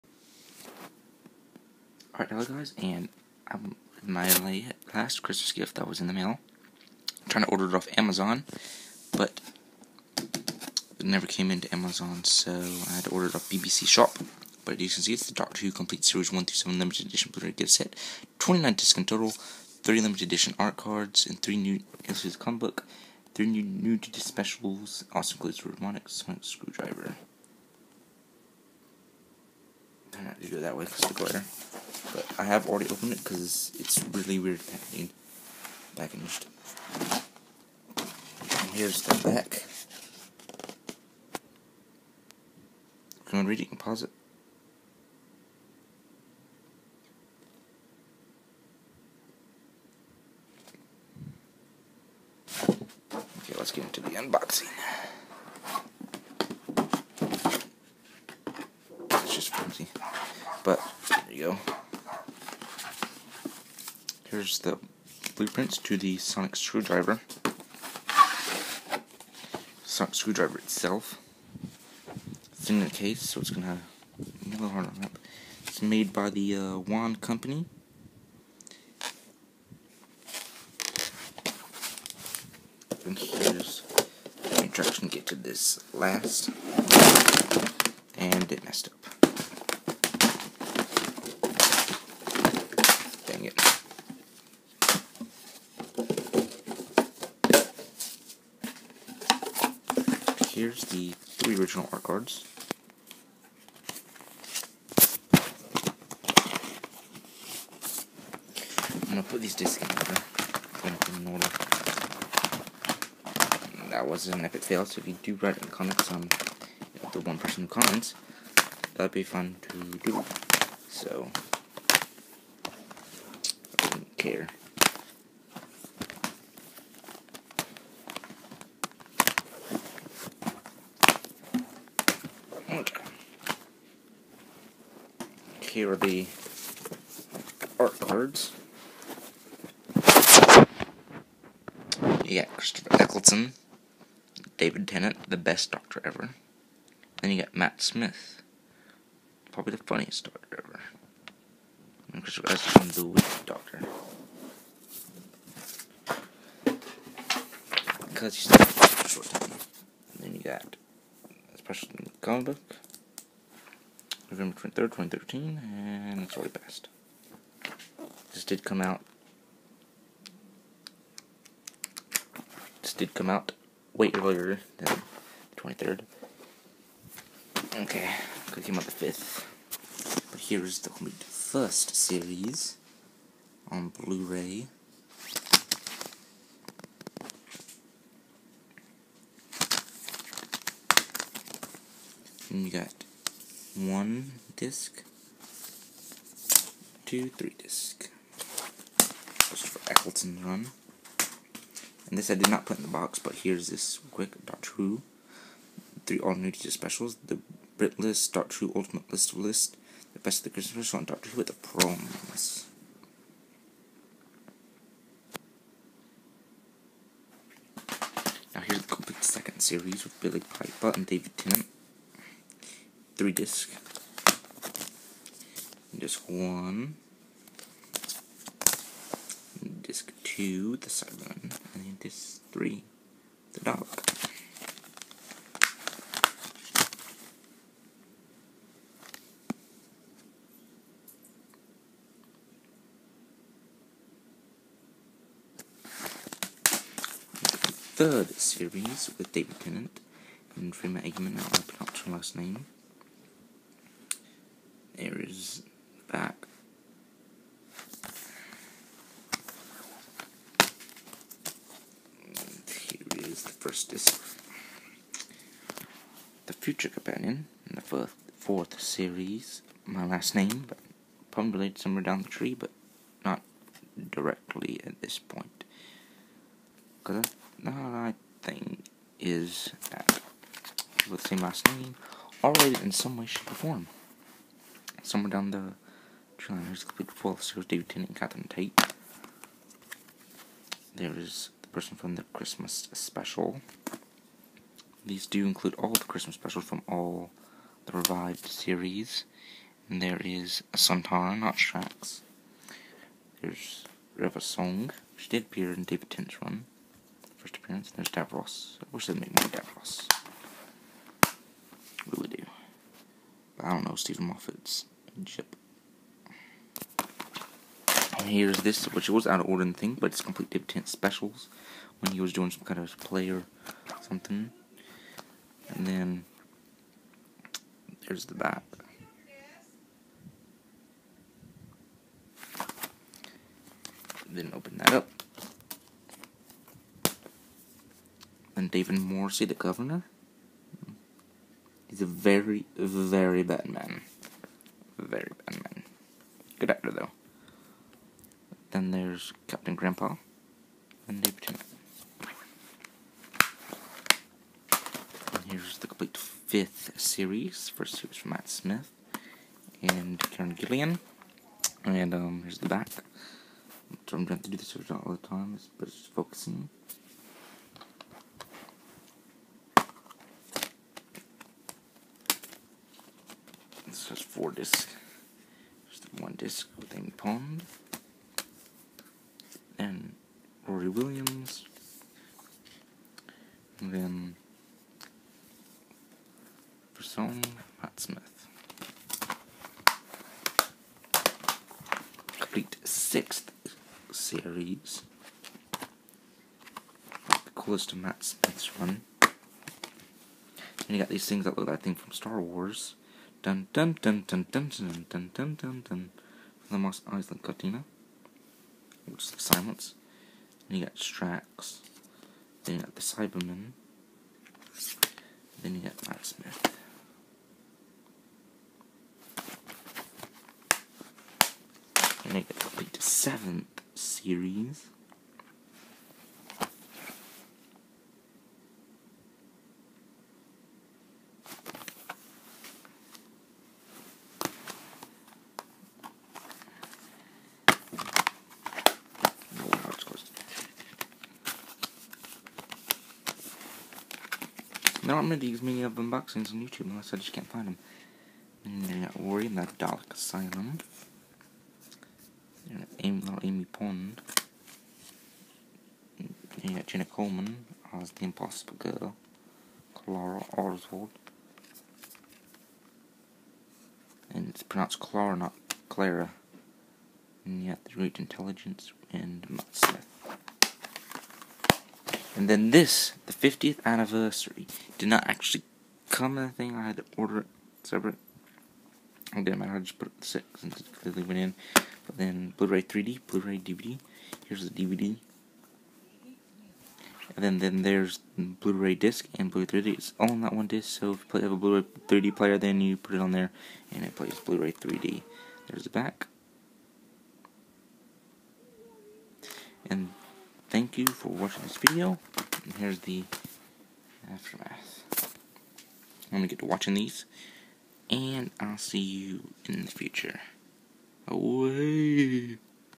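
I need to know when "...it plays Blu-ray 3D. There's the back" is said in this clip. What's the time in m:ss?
8:14.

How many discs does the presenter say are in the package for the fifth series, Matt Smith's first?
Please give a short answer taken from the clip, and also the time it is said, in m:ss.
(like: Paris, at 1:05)
4, at 6:14.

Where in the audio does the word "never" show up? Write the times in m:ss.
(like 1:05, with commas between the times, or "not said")
0:11.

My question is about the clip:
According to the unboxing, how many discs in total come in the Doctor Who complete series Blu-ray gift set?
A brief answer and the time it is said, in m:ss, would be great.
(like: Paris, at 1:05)
29, at 0:18.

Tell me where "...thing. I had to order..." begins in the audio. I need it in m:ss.
7:56.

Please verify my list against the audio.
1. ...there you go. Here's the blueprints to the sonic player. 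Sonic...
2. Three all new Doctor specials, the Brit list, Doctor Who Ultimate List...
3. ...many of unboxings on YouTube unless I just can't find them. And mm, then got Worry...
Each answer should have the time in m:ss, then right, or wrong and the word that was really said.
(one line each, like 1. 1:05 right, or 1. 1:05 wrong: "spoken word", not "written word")
1. 1:01 wrong: "screwdriver", not "player"
2. 3:26 right
3. 7:25 right.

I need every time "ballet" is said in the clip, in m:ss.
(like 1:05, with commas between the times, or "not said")
not said.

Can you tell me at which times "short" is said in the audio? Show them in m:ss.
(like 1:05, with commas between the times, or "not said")
2:39.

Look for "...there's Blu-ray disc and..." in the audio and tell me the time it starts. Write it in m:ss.
8:07.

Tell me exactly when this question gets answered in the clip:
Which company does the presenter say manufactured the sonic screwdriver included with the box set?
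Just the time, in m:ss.
1:16.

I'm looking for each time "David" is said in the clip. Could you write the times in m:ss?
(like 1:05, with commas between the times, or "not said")
2:24, 3:41, 4:09, 4:47, 5:05, 5:38.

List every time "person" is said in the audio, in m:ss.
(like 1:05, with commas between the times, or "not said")
1:57, 4:51, 6:26.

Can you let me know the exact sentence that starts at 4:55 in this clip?
These do include all the Christmas specials from all the revived series.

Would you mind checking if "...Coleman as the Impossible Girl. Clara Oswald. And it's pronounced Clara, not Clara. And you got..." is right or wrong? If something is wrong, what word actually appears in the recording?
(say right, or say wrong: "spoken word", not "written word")
right.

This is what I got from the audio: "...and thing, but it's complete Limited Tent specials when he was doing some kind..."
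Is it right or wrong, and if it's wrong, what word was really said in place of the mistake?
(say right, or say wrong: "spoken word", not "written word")
wrong: "Dave", not "Limited".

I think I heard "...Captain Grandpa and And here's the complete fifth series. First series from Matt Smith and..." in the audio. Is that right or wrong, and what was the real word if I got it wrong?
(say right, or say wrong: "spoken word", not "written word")
right.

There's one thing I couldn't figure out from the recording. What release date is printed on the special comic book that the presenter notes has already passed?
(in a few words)
November 23rd, 2013.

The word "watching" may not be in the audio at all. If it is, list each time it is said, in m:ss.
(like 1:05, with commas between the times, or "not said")
8:21, 8:26.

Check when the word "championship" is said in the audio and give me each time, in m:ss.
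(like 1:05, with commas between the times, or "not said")
5:15.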